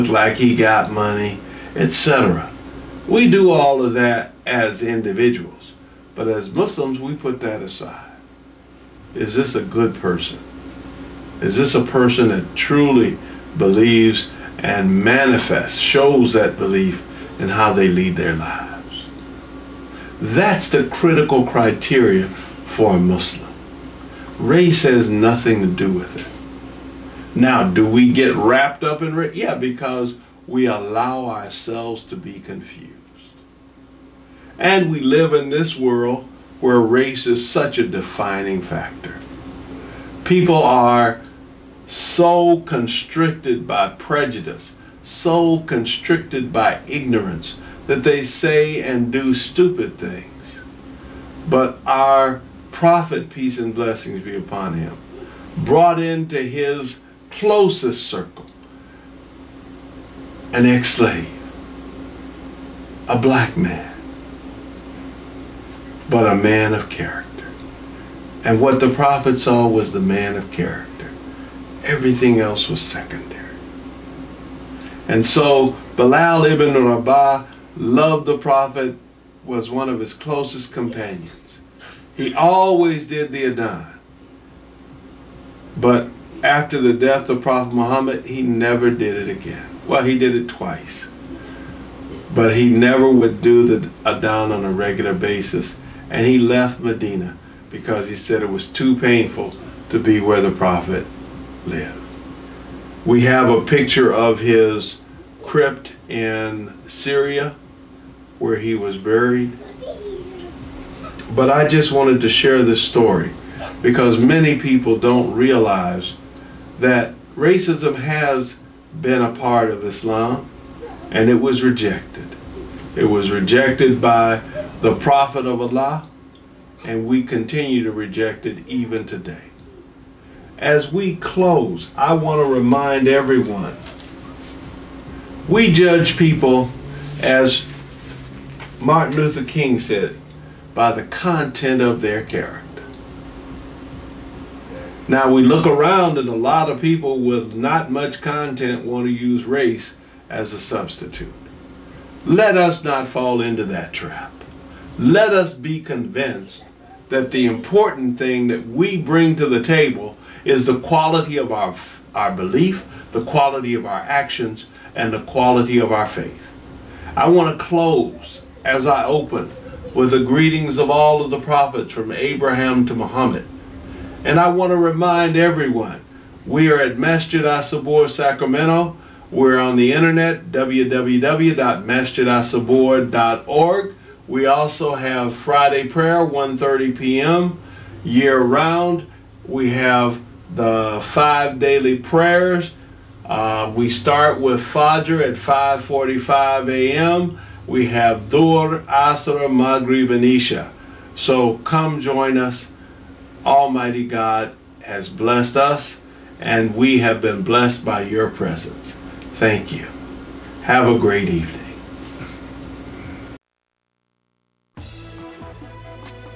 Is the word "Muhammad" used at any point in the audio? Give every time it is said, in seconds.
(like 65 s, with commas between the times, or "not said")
87 s, 172 s.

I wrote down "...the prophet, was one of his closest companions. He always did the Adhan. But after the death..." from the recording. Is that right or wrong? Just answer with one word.
right.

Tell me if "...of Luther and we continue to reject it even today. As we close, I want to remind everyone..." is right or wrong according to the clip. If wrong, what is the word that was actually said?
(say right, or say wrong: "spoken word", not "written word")
wrong: "Allah", not "Luther".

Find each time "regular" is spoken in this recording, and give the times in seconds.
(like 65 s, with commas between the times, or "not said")
94 s.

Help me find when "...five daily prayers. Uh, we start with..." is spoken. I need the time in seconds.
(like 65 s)
191 s.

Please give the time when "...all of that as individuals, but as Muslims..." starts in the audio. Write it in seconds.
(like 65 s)
3 s.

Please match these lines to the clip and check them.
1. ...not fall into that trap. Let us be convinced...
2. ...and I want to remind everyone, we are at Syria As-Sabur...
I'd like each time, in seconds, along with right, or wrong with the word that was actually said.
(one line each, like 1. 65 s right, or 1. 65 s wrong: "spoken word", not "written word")
1. 152 s right
2. 174 s wrong: "Masjid", not "Syria".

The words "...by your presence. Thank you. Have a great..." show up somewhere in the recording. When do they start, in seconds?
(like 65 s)
207 s.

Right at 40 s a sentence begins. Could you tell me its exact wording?
People are so constricted by prejudice, so constricted by ignorance, that they say and do stupid things.